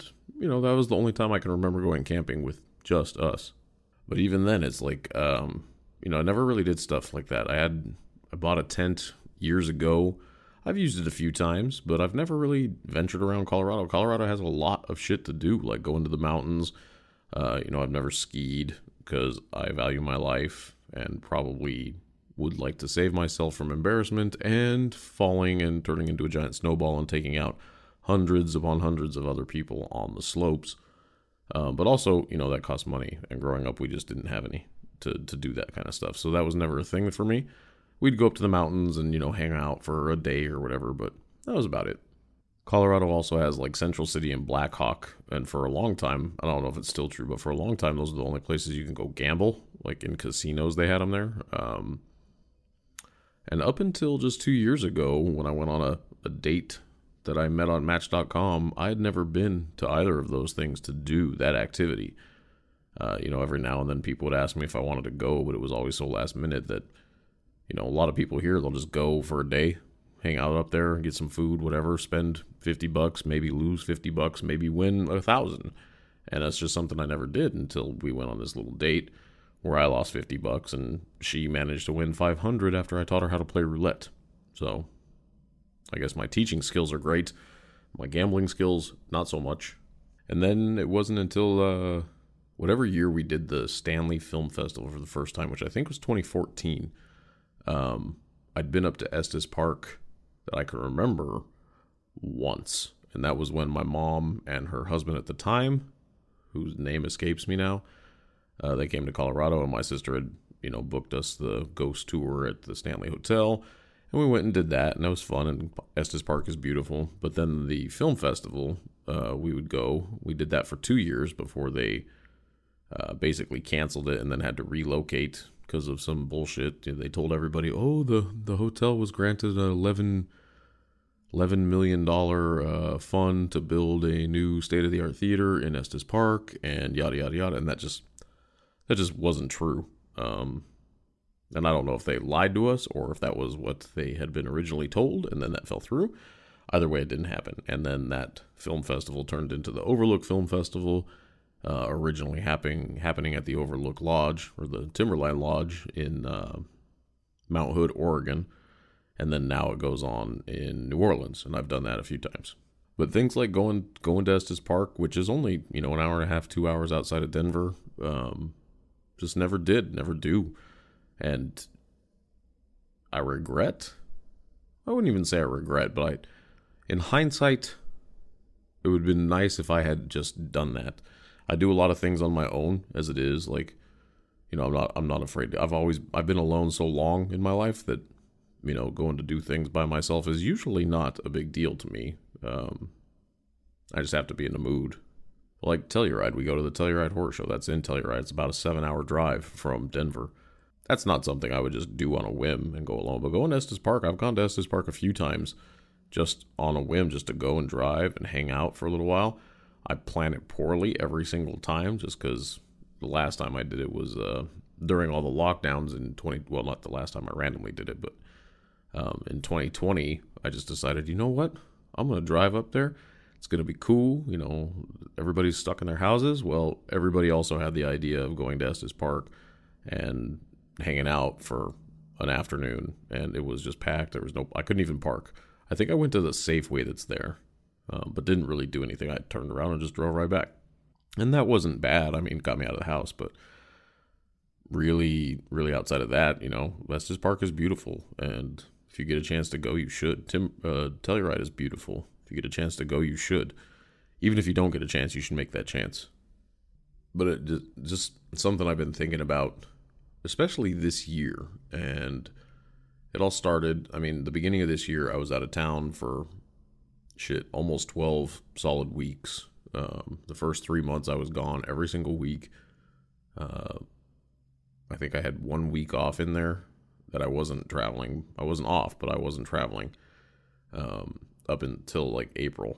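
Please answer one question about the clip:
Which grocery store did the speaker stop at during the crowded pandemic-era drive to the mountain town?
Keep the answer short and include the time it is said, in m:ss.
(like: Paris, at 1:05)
Safeway, at 3:56.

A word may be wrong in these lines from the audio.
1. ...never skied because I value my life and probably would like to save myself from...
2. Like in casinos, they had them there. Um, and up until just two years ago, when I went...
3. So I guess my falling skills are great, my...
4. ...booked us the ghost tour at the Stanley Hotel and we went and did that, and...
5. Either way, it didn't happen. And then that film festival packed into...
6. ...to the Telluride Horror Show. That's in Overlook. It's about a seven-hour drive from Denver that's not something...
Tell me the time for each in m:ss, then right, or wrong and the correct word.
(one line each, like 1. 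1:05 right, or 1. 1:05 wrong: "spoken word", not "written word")
1. 0:17 right
2. 0:49 right
3. 1:24 wrong: "teaching", not "falling"
4. 1:50 right
5. 2:26 wrong: "turned", not "packed"
6. 3:16 wrong: "Telluride", not "Overlook".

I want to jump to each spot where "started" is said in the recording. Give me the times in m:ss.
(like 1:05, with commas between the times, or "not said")
4:23.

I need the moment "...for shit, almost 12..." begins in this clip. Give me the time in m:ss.
4:25.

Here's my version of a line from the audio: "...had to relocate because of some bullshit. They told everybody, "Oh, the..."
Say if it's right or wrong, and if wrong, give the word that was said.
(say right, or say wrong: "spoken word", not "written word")
right.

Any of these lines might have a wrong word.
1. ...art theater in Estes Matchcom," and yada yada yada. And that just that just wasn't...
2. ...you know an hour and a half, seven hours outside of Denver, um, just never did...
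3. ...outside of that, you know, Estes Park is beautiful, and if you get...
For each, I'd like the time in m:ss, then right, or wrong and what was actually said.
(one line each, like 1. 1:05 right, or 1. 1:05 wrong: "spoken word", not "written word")
1. 2:14 wrong: "Park", not "Matchcom"
2. 2:45 wrong: "two", not "seven"
3. 4:05 right.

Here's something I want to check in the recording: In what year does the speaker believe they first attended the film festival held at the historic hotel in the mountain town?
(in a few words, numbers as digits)
2014.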